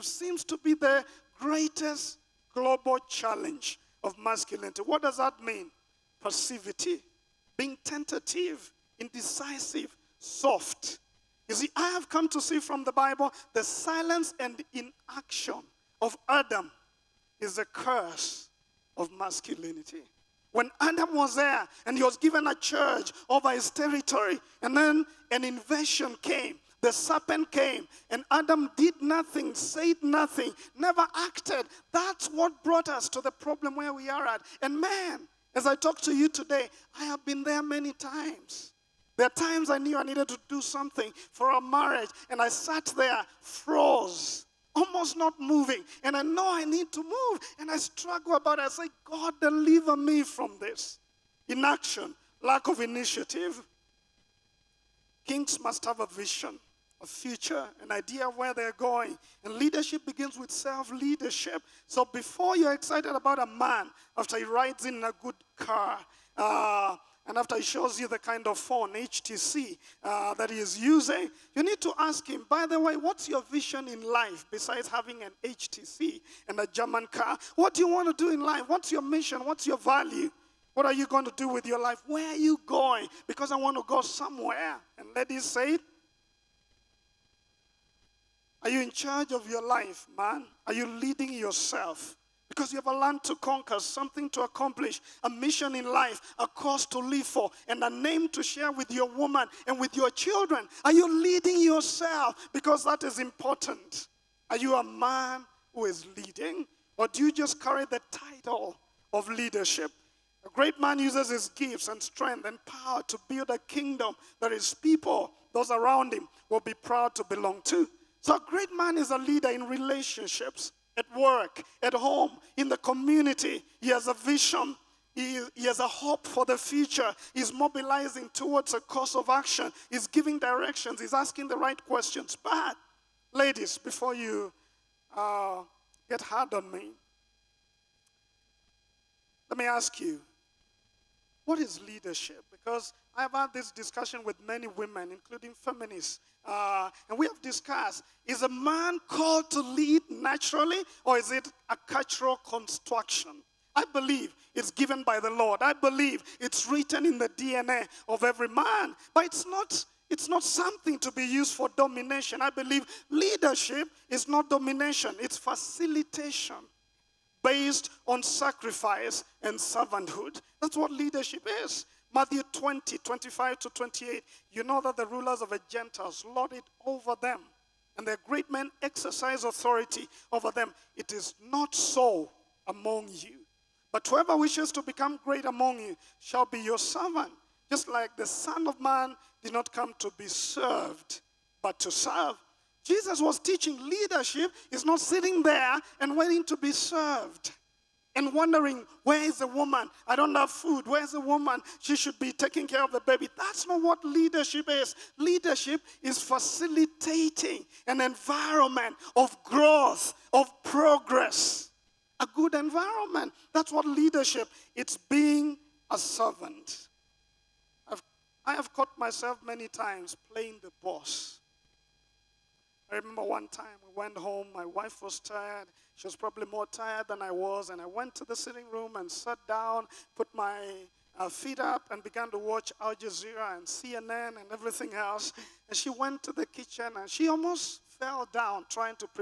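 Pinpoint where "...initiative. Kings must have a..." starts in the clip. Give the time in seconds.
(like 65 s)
52 s.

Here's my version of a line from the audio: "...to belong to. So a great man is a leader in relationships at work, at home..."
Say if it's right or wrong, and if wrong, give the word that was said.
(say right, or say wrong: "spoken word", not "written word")
right.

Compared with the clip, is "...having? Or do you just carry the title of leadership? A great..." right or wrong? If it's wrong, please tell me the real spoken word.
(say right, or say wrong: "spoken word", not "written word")
wrong: "leading", not "having".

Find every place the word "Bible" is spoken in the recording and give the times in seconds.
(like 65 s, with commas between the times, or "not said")
12 s.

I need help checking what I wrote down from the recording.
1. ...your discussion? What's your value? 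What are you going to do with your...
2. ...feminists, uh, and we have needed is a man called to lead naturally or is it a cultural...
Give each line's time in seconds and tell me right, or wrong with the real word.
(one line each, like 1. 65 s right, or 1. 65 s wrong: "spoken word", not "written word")
1. 78 s wrong: "mission", not "discussion"
2. 145 s wrong: "discussed", not "needed".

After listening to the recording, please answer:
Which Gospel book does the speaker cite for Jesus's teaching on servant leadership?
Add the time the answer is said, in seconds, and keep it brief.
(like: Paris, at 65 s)
Matthew, at 172 s.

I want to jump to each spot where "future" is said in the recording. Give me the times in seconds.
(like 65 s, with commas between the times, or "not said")
57 s, 126 s.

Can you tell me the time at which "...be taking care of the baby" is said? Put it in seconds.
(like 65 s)
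202 s.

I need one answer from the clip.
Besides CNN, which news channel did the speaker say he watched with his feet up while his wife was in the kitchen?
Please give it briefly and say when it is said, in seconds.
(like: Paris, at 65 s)
Al Jazeera, at 232 s.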